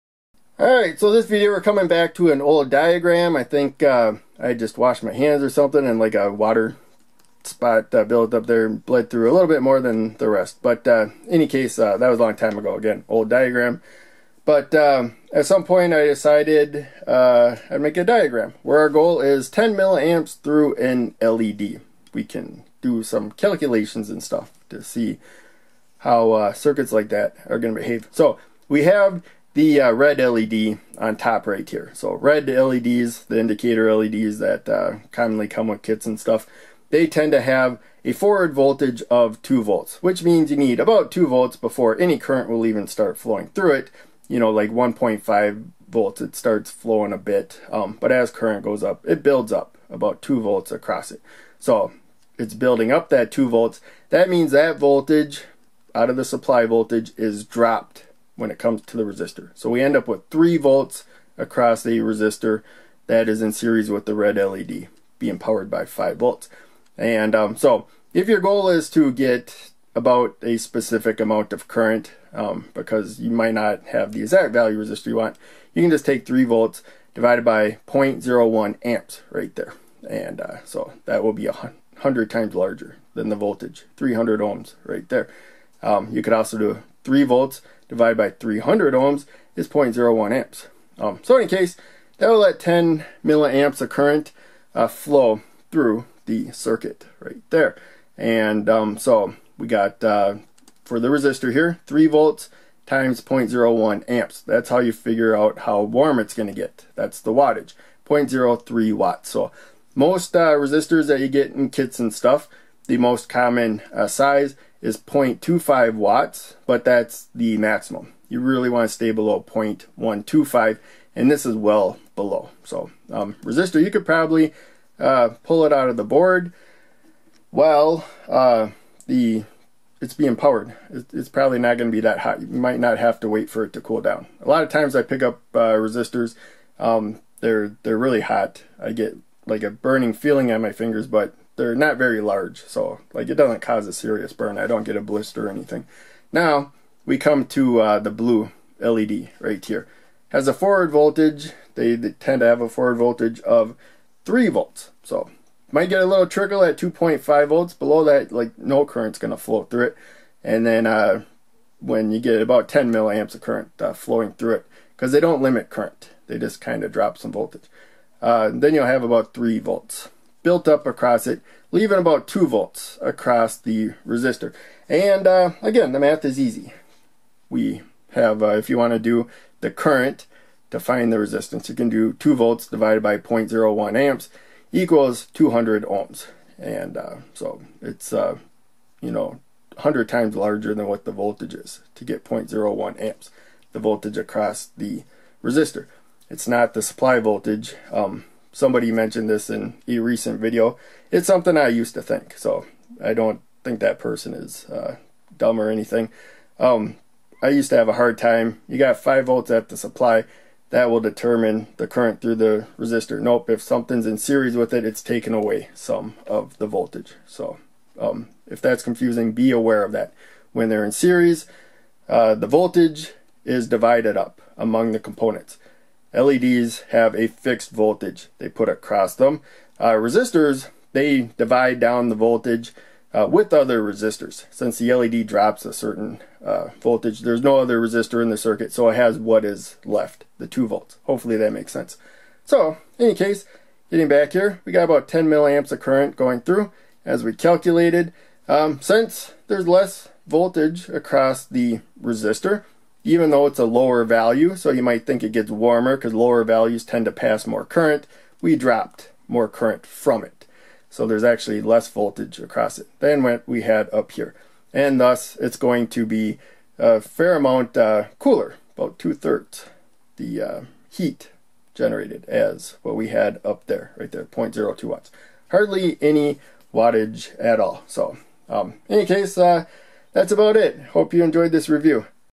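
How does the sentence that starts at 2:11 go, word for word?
It's probably not going to be that hot.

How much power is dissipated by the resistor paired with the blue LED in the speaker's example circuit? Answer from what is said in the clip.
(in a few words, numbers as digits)
0.02 watts.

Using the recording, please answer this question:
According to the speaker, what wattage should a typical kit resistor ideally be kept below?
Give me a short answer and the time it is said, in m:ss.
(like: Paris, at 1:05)
0.125, at 1:59.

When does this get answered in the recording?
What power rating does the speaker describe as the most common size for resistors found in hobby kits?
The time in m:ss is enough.
1:54.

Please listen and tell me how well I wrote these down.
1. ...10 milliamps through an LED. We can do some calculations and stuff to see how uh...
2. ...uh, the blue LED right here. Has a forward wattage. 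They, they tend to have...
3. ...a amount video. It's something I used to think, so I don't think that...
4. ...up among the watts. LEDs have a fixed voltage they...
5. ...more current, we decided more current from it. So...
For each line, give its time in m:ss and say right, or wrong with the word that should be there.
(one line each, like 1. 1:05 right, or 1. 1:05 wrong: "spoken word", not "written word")
1. 0:19 right
2. 2:27 wrong: "voltage", not "wattage"
3. 3:19 wrong: "recent", not "amount"
4. 3:44 wrong: "components", not "watts"
5. 4:17 wrong: "dropped", not "decided".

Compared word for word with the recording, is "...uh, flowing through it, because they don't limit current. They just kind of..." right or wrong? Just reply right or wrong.
right.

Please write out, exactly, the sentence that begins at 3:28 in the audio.
You got 5 volts at the supply.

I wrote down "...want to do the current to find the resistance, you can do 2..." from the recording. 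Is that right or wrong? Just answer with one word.
right.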